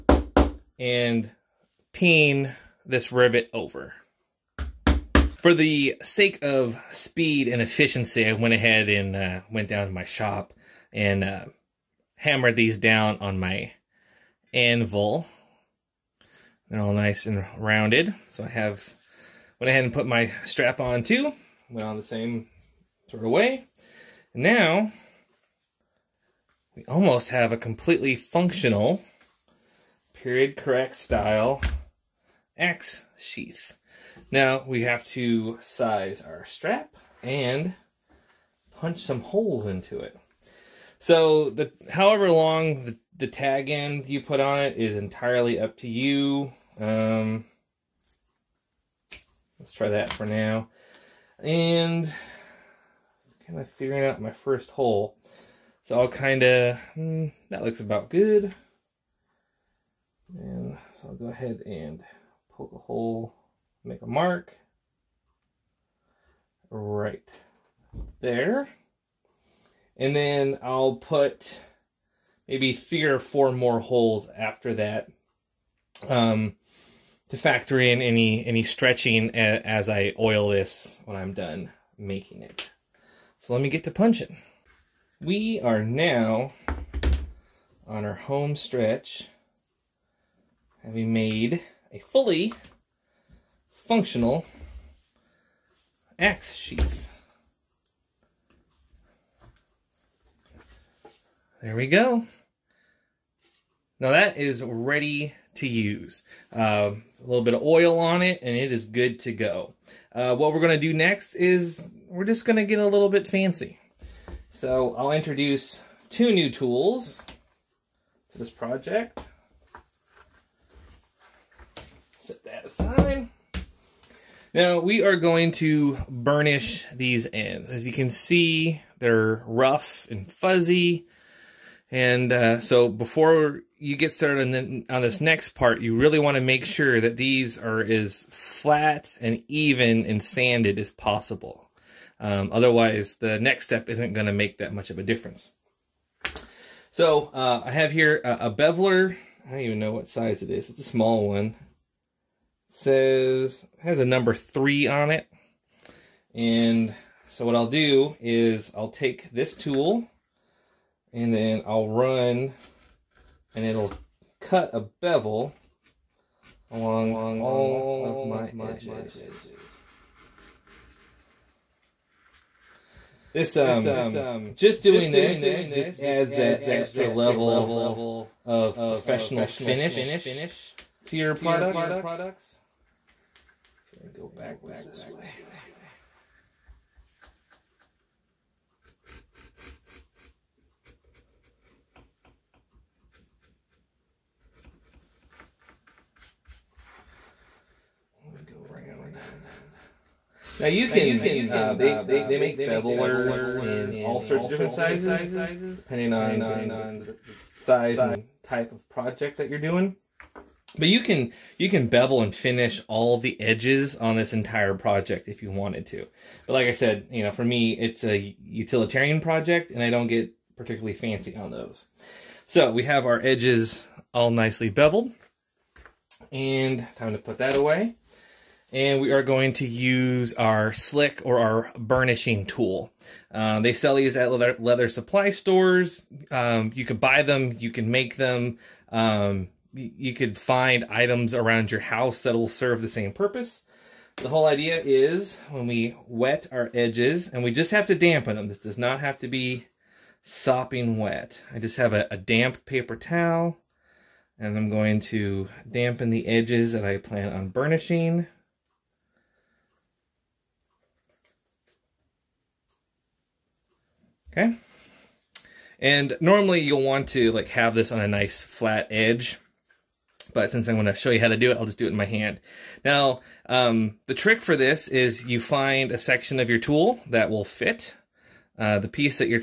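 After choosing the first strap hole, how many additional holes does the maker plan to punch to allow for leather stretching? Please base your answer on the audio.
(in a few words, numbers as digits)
3 or 4.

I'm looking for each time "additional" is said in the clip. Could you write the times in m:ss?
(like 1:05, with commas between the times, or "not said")
not said.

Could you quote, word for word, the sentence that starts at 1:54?
So I'll introduce two new tools to this project.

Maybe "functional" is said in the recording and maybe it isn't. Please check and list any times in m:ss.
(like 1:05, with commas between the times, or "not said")
0:28, 1:33.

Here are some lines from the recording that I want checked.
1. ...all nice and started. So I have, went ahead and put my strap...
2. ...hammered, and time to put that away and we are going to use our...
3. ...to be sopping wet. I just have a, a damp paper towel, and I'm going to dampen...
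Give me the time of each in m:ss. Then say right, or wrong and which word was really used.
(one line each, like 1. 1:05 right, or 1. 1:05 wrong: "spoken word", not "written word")
1. 0:16 wrong: "rounded", not "started"
2. 3:44 wrong: "beveled", not "hammered"
3. 4:09 right.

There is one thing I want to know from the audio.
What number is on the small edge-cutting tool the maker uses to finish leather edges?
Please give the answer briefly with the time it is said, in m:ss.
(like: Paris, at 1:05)
3, at 2:34.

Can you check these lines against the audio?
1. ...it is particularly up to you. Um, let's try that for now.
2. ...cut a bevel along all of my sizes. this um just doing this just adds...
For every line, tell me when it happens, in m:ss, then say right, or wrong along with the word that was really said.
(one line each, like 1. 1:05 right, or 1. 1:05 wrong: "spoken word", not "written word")
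1. 0:44 wrong: "entirely", not "particularly"
2. 2:44 wrong: "edges", not "sizes".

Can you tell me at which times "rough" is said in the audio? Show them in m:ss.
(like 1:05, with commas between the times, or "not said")
2:09.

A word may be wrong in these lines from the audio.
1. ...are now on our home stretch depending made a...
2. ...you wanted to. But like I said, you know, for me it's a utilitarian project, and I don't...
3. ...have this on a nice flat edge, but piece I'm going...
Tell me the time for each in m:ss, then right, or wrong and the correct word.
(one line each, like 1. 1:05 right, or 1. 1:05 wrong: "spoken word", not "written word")
1. 1:25 wrong: "having", not "depending"
2. 3:35 right
3. 4:27 wrong: "since", not "piece".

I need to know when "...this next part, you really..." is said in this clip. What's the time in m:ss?
2:15.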